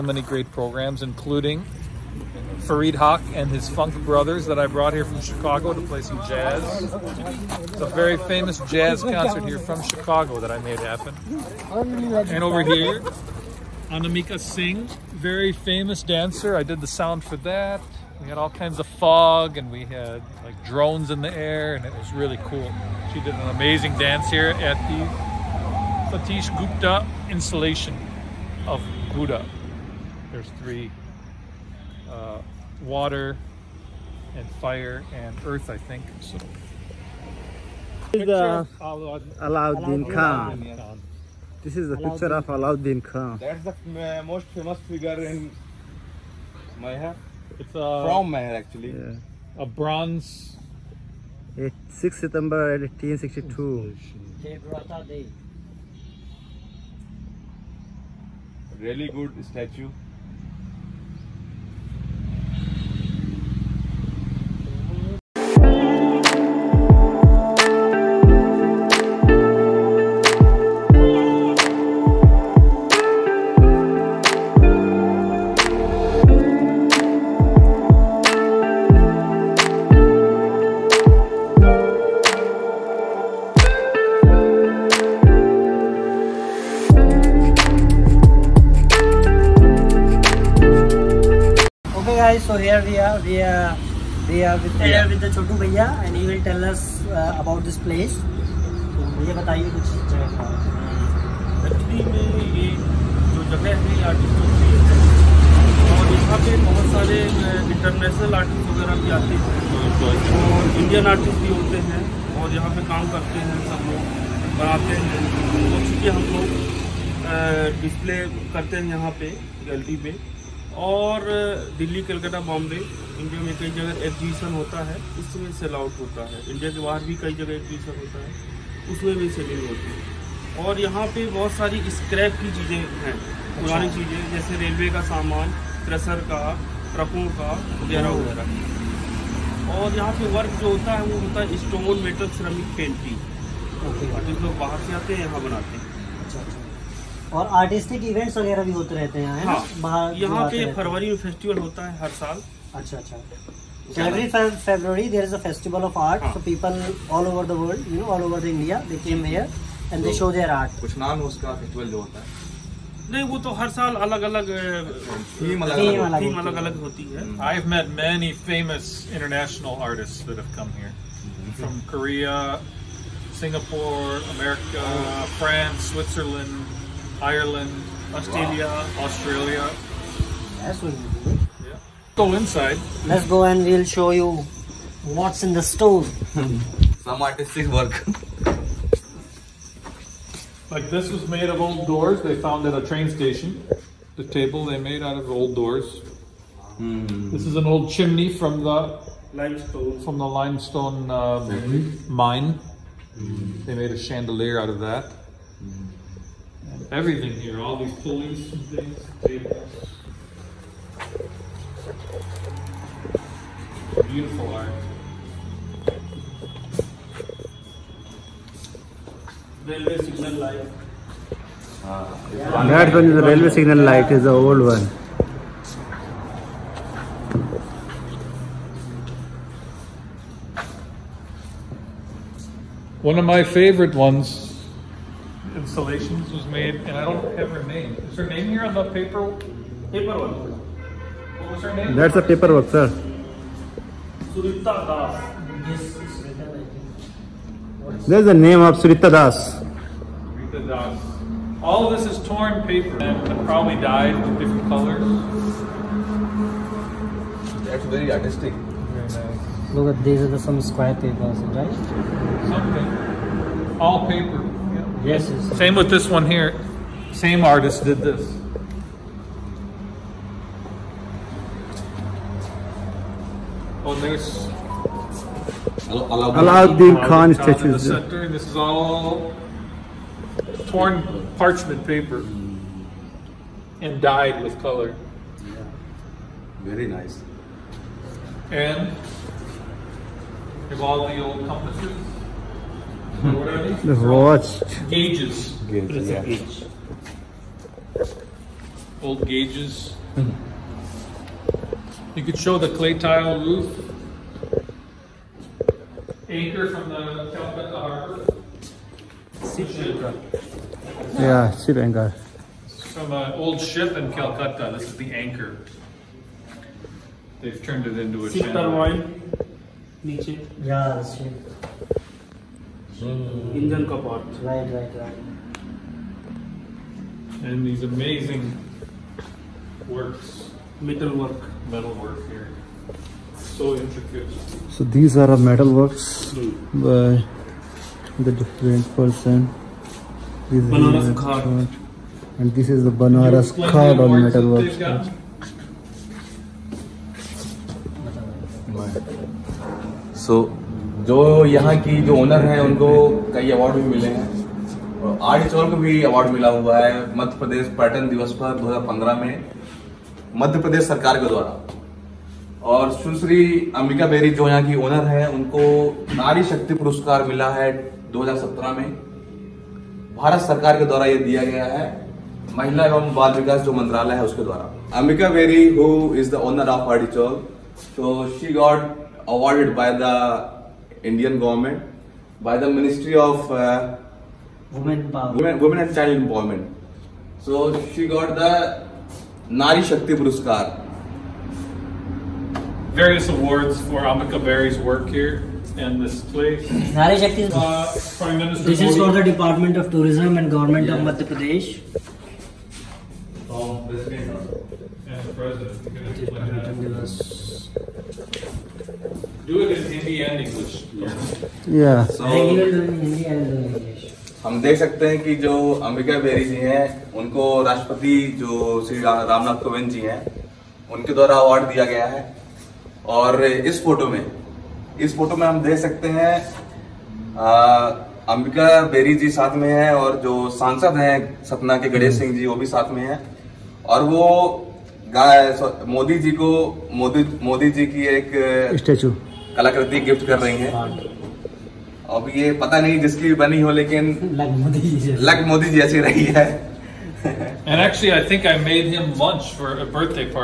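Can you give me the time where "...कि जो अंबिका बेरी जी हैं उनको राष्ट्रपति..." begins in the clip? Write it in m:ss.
6:55.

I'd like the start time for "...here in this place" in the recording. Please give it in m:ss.
6:35.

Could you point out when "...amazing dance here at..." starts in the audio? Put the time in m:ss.
0:23.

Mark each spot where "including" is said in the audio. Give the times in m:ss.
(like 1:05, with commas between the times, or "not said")
0:01.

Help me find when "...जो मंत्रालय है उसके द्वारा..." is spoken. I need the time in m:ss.
6:13.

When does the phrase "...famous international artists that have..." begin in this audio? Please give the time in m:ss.
2:48.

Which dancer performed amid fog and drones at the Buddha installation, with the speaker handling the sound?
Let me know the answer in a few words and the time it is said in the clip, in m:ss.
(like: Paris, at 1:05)
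Anamika Singh, at 0:13.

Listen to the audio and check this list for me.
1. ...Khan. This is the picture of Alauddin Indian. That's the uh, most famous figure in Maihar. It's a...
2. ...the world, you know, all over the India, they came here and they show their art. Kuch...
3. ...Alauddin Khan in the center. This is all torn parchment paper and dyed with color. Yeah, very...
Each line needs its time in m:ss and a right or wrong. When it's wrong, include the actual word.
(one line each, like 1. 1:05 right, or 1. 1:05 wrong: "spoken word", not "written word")
1. 0:40 wrong: "Khan", not "Indian"
2. 2:37 right
3. 4:35 right.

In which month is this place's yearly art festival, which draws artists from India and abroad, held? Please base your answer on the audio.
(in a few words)
February.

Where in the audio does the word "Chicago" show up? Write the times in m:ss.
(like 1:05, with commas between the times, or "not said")
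0:05, 0:09.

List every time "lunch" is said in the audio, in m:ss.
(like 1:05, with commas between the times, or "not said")
7:29.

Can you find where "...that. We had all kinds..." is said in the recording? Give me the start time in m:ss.
0:17.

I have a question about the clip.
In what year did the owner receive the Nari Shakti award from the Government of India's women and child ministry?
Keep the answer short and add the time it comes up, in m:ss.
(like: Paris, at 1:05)
2017, at 6:08.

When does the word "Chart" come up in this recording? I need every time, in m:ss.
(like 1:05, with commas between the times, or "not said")
5:41.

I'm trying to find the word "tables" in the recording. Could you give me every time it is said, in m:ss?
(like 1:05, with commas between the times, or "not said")
3:14, 3:29, 4:20.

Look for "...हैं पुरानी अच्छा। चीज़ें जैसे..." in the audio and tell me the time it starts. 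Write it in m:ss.
2:13.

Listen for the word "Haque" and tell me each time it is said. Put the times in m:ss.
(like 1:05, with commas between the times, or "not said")
0:02.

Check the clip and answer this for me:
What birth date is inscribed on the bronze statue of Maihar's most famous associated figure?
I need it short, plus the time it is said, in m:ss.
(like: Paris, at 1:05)
6 September 1862, at 0:51.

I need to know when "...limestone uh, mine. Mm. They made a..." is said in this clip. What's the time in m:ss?
3:20.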